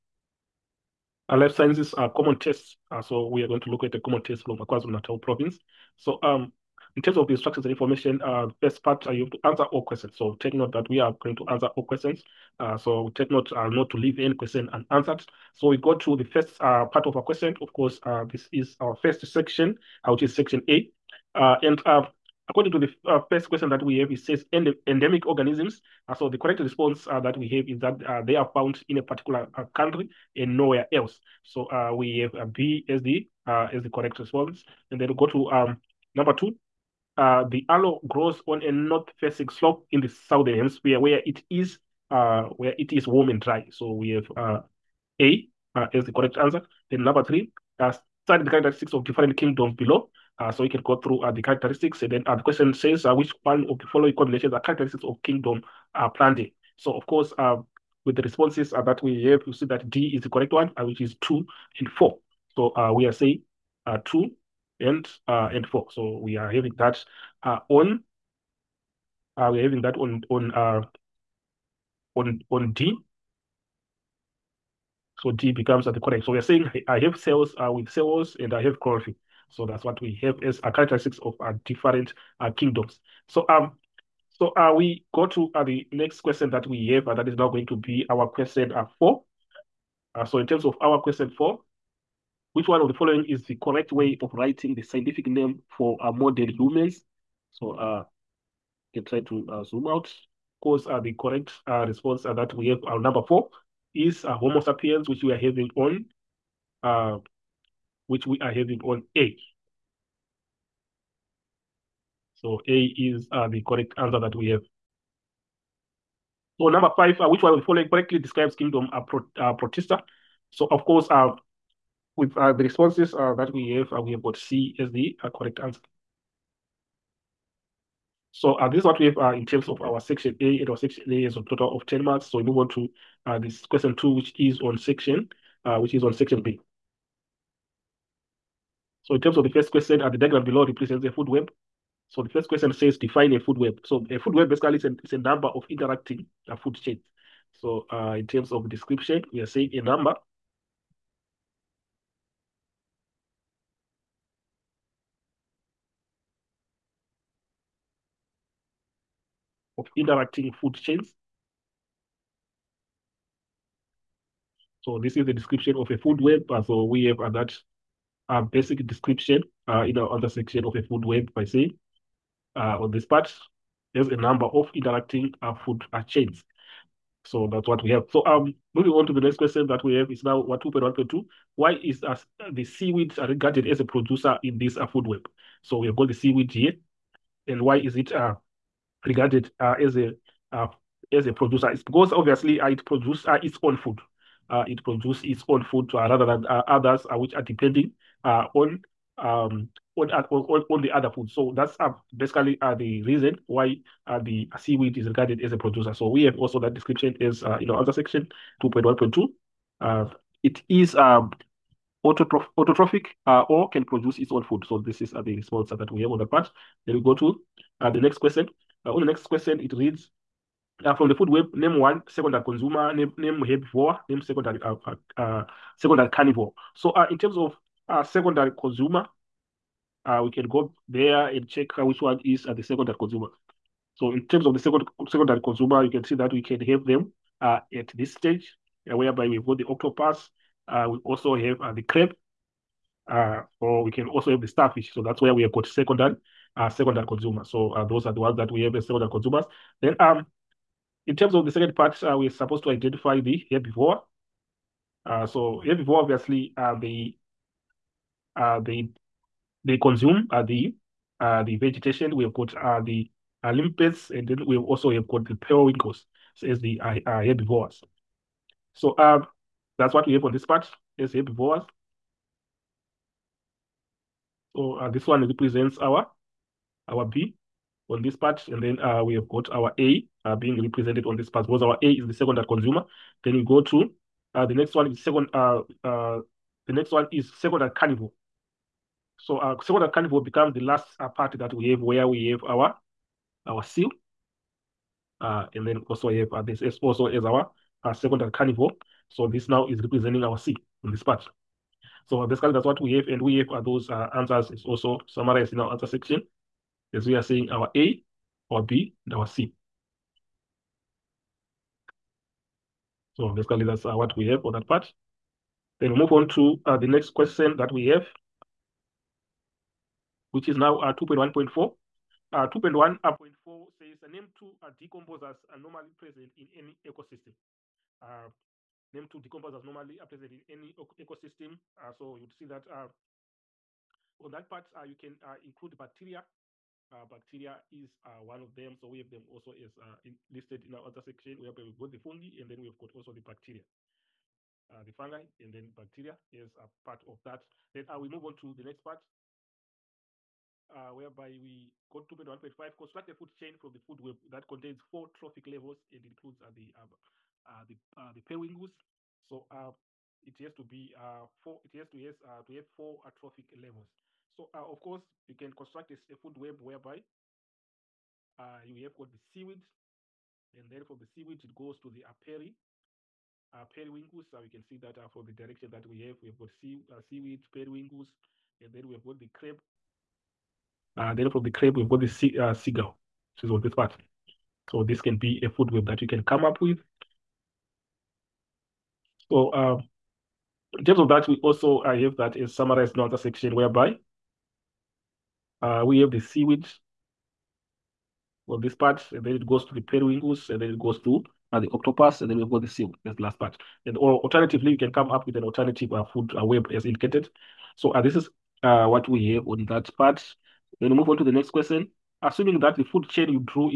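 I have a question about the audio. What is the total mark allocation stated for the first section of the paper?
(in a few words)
10 marks.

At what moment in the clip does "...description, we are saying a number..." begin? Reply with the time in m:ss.
2:28.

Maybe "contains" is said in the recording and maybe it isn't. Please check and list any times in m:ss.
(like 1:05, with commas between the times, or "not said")
5:54.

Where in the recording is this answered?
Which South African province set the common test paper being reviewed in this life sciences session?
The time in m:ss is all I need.
0:04.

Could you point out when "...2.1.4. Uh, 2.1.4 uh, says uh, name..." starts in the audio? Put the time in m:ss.
5:20.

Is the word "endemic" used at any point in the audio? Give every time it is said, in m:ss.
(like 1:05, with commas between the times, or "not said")
0:24.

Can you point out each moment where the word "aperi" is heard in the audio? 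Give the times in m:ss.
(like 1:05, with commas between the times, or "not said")
6:12.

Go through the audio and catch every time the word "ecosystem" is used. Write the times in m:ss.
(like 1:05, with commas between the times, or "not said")
5:26, 5:30.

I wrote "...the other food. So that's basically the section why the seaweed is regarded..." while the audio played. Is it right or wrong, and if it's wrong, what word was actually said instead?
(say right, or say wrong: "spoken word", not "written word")
wrong: "reason", not "section".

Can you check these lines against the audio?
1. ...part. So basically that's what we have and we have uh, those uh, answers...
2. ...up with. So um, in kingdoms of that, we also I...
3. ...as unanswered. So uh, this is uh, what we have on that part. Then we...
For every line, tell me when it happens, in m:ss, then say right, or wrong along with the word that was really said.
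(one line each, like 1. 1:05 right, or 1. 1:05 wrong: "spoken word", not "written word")
1. 5:01 right
2. 6:26 wrong: "terms", not "kingdoms"
3. 6:46 wrong: "indicated", not "unanswered".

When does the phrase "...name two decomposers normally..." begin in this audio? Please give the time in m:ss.
5:28.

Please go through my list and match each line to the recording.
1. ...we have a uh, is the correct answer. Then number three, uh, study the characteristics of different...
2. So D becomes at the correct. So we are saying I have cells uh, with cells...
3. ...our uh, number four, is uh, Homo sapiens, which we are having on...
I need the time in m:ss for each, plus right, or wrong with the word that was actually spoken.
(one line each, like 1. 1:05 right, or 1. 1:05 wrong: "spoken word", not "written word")
1. 0:43 right
2. 1:15 right
3. 1:42 right.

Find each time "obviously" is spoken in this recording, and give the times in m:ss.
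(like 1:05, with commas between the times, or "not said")
3:12, 4:16.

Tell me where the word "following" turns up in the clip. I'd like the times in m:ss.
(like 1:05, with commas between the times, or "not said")
0:53, 1:32, 1:57.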